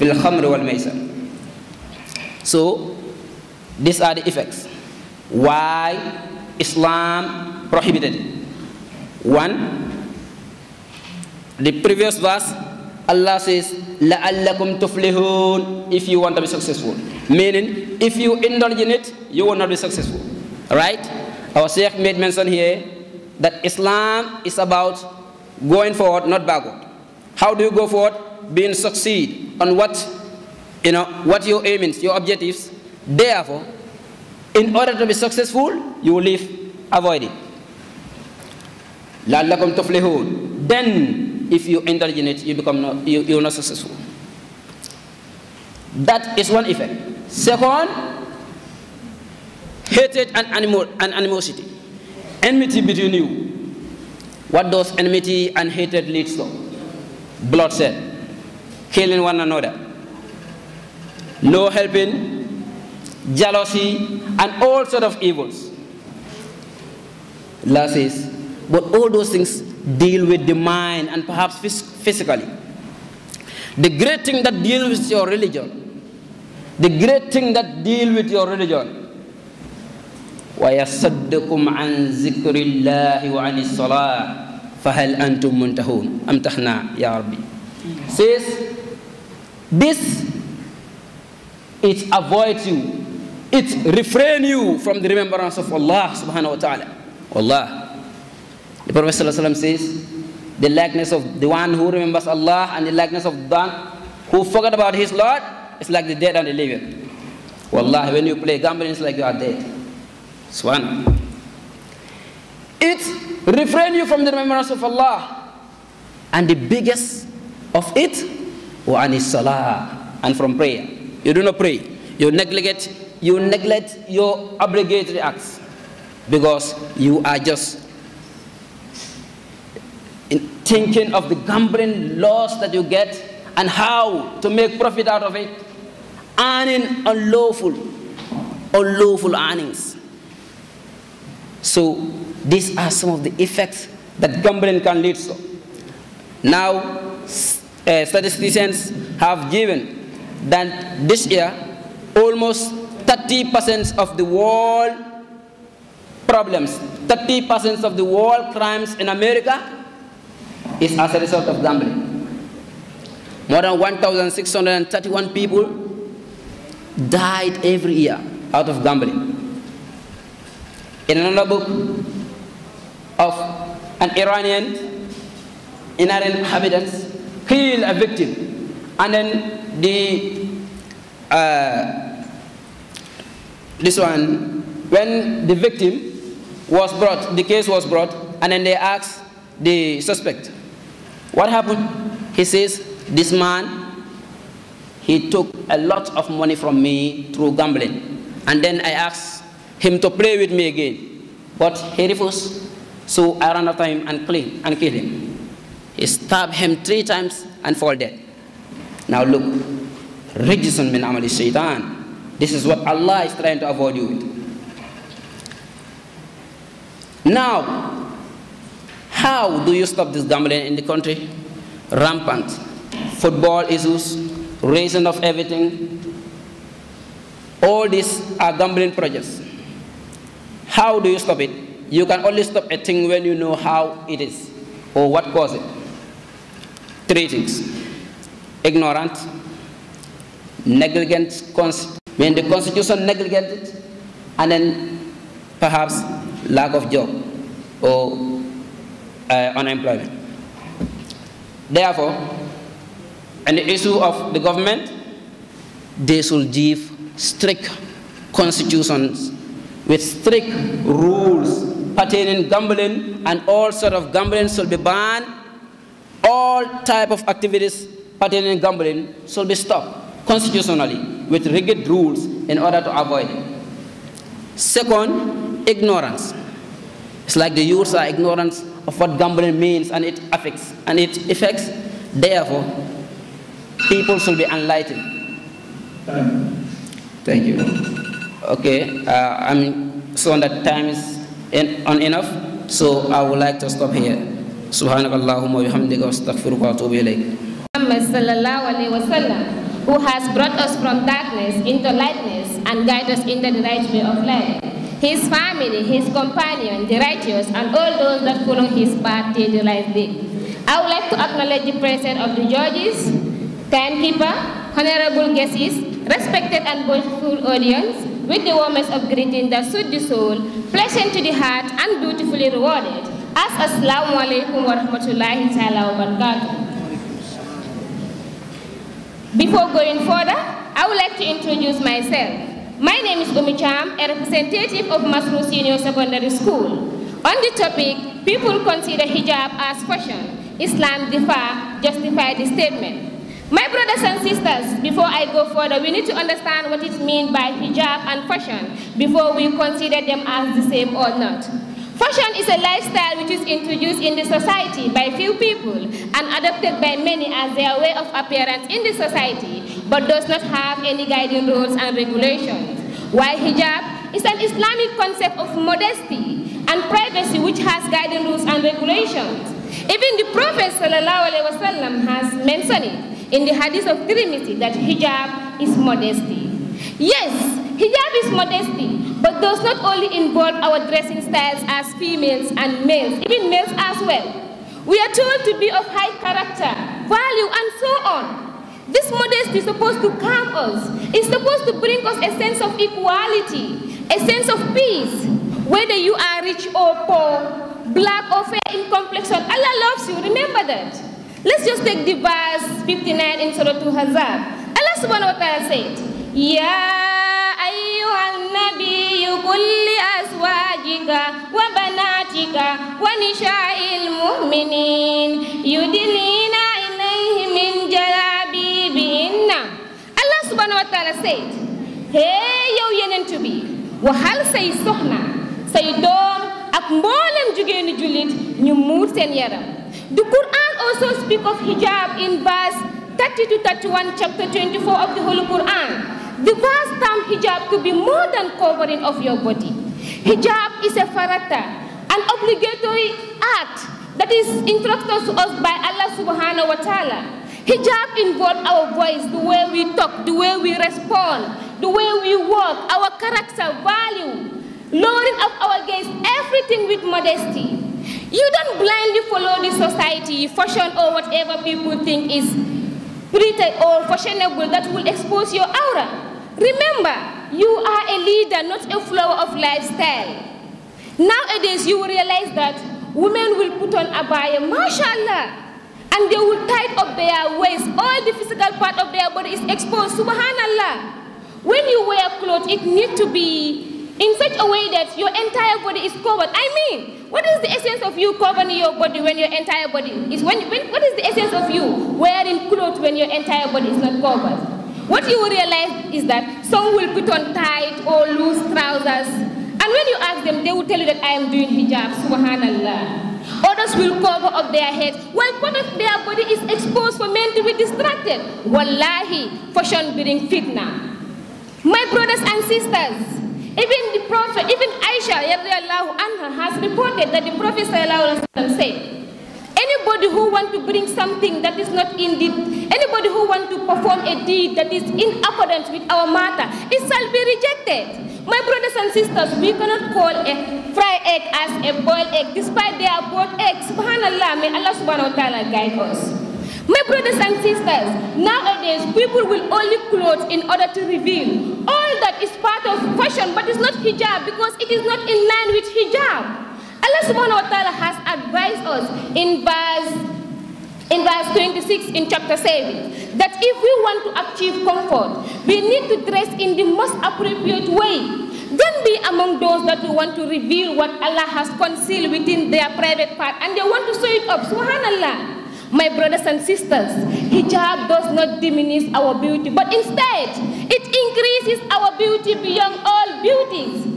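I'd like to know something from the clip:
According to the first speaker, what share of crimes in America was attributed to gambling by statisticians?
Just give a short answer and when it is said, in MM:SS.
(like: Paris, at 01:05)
30%, at 02:37.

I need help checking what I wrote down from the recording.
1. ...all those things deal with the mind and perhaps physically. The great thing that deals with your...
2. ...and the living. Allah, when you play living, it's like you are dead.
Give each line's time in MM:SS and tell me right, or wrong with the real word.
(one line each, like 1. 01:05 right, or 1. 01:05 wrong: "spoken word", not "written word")
1. 01:08 right
2. 01:46 wrong: "gambling", not "living".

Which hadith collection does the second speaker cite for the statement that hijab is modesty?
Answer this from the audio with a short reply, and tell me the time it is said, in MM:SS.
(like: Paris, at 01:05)
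Tirmidhi, at 06:14.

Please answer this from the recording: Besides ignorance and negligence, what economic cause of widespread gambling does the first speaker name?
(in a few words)
Unemployment.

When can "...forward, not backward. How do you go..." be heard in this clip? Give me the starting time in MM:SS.
00:25.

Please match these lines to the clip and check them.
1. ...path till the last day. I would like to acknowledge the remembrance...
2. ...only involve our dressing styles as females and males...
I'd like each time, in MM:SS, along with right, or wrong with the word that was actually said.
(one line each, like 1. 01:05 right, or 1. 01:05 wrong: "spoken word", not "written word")
1. 05:09 wrong: "presence", not "remembrance"
2. 06:19 right.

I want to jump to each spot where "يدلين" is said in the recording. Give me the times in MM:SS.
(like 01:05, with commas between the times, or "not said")
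06:55.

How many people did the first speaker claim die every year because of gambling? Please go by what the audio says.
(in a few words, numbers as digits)
1,631.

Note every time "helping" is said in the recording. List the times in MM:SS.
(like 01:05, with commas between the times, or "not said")
01:01.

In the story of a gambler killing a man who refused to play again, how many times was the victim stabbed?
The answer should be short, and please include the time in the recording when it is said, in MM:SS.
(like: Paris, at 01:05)
3, at 03:26.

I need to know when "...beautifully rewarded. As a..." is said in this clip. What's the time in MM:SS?
05:21.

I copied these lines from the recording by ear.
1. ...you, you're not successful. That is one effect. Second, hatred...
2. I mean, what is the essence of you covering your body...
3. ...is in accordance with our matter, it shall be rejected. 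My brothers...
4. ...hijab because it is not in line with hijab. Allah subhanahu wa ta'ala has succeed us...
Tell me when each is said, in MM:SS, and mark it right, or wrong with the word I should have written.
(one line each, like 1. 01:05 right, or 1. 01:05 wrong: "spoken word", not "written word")
1. 00:43 right
2. 08:06 right
3. 08:44 right
4. 09:03 wrong: "advised", not "succeed".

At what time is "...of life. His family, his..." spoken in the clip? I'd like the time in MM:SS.
05:04.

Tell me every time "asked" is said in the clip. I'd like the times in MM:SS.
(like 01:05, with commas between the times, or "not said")
03:08, 03:18.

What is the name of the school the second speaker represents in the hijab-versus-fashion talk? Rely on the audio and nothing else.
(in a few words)
Masroor Senior Secondary School.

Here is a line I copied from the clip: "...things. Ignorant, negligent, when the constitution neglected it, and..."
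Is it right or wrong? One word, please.
right.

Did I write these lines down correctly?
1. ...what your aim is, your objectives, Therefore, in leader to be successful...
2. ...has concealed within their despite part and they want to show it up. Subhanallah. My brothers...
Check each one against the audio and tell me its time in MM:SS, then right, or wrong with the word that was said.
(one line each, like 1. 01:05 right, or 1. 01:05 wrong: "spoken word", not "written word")
1. 00:31 wrong: "order", not "leader"
2. 09:21 wrong: "private", not "despite".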